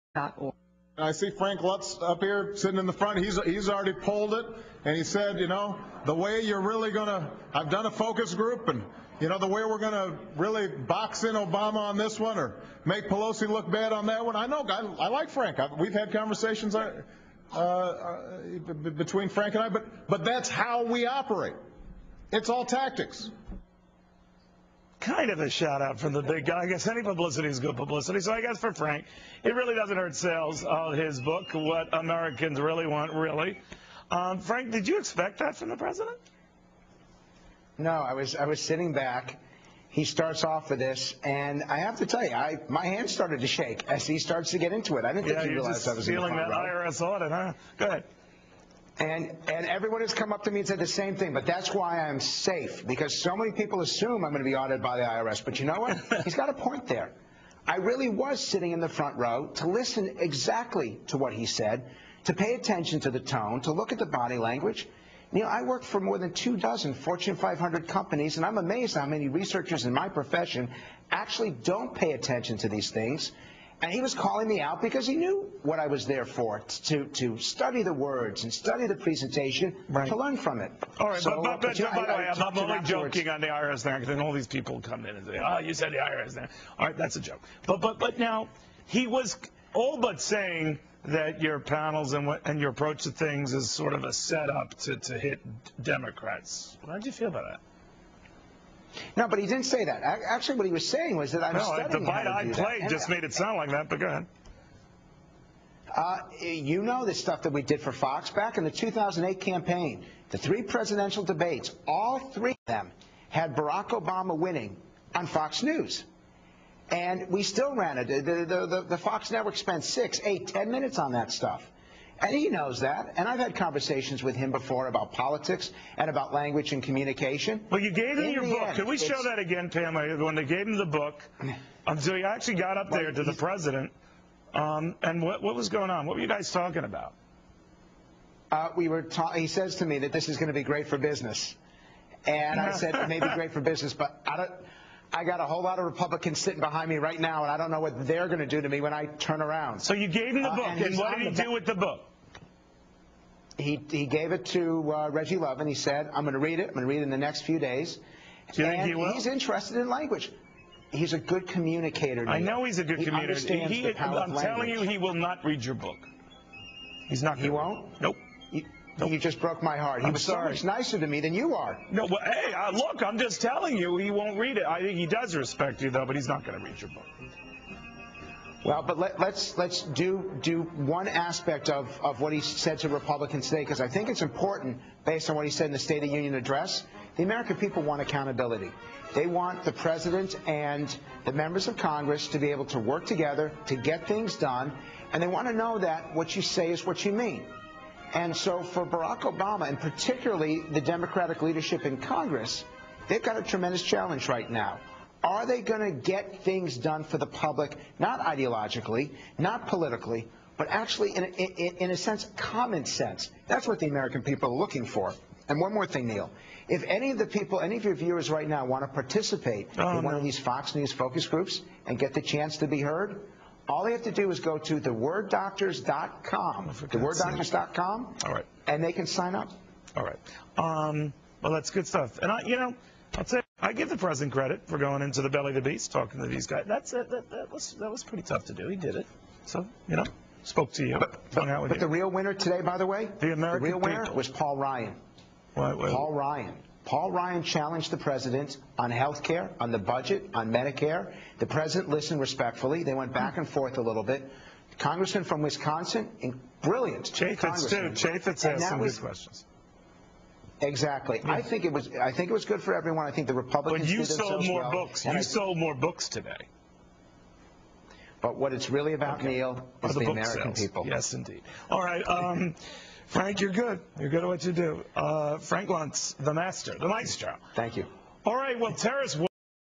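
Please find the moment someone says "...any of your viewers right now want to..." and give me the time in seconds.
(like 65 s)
217 s.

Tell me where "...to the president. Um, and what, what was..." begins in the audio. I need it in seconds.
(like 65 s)
133 s.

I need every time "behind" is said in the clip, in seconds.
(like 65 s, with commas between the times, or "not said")
146 s.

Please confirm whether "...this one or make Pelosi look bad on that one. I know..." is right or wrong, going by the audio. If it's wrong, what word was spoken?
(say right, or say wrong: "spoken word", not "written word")
right.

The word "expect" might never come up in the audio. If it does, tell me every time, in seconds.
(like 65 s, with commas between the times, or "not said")
34 s.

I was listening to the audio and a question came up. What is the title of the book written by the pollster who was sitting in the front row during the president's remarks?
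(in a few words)
What Americans Really Want, Really.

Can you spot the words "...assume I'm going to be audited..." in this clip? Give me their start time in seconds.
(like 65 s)
53 s.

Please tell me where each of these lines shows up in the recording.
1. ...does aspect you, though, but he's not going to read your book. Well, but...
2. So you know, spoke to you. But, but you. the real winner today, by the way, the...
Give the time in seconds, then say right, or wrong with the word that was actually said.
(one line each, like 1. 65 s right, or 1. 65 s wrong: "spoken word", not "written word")
1. 175 s wrong: "respect", not "aspect"
2. 239 s right.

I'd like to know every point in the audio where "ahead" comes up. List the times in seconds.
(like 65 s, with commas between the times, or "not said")
47 s, 104 s.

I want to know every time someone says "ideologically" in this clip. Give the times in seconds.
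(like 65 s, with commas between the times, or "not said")
208 s.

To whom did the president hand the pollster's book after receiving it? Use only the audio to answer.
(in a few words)
Reggie Love.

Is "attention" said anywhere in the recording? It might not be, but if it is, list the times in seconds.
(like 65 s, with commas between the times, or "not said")
62 s, 72 s.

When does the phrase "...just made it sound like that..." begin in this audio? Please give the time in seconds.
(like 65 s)
102 s.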